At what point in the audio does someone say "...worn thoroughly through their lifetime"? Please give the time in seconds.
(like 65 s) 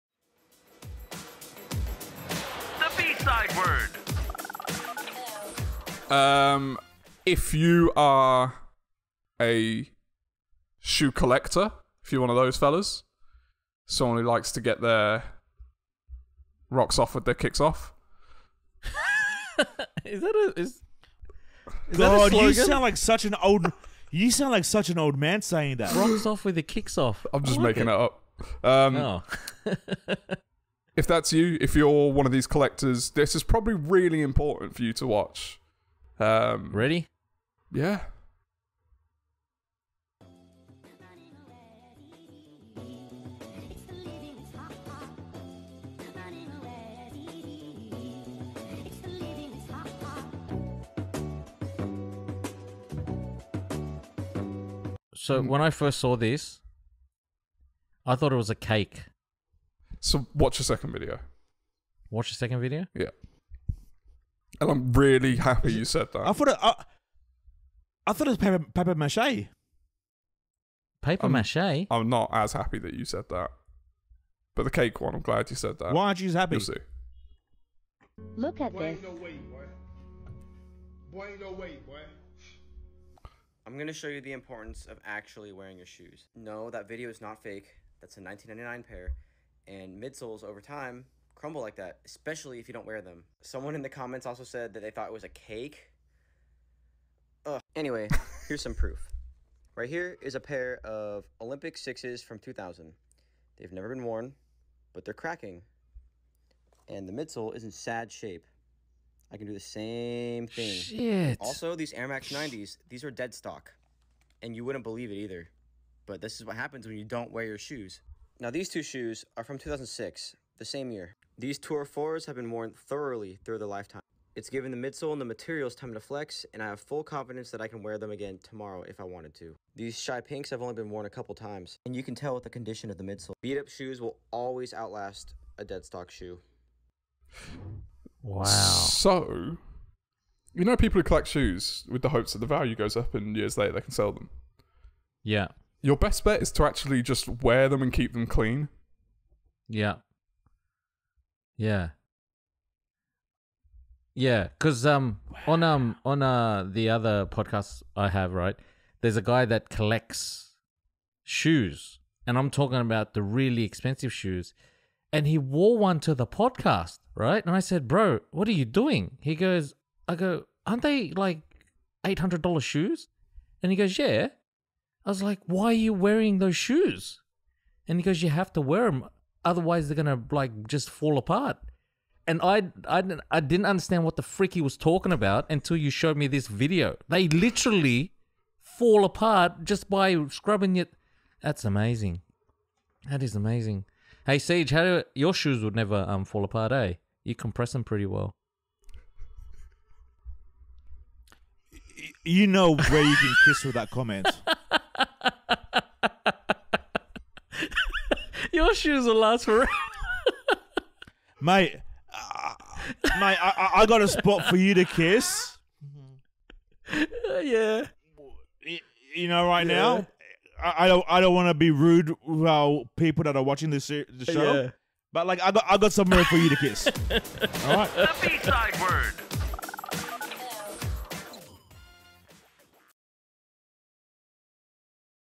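122 s.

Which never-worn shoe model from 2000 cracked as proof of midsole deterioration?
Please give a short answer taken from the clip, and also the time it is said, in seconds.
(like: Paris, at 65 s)
Olympic sixes, at 101 s.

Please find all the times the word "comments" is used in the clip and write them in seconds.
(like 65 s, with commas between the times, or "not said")
93 s, 203 s.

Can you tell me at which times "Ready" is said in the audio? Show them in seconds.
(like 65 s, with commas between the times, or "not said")
36 s.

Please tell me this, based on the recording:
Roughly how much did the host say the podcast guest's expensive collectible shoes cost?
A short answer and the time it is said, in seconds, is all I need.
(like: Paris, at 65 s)
$800, at 172 s.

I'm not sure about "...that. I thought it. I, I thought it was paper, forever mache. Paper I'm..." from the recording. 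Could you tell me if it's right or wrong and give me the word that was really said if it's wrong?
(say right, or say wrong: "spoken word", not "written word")
wrong: "paper", not "forever".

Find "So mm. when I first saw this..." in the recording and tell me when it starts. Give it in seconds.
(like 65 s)
55 s.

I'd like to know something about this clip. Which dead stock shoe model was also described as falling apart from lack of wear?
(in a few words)
Air Max 90s.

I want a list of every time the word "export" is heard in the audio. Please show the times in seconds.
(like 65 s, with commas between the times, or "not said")
not said.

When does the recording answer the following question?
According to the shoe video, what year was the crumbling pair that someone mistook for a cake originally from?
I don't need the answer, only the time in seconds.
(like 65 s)
88 s.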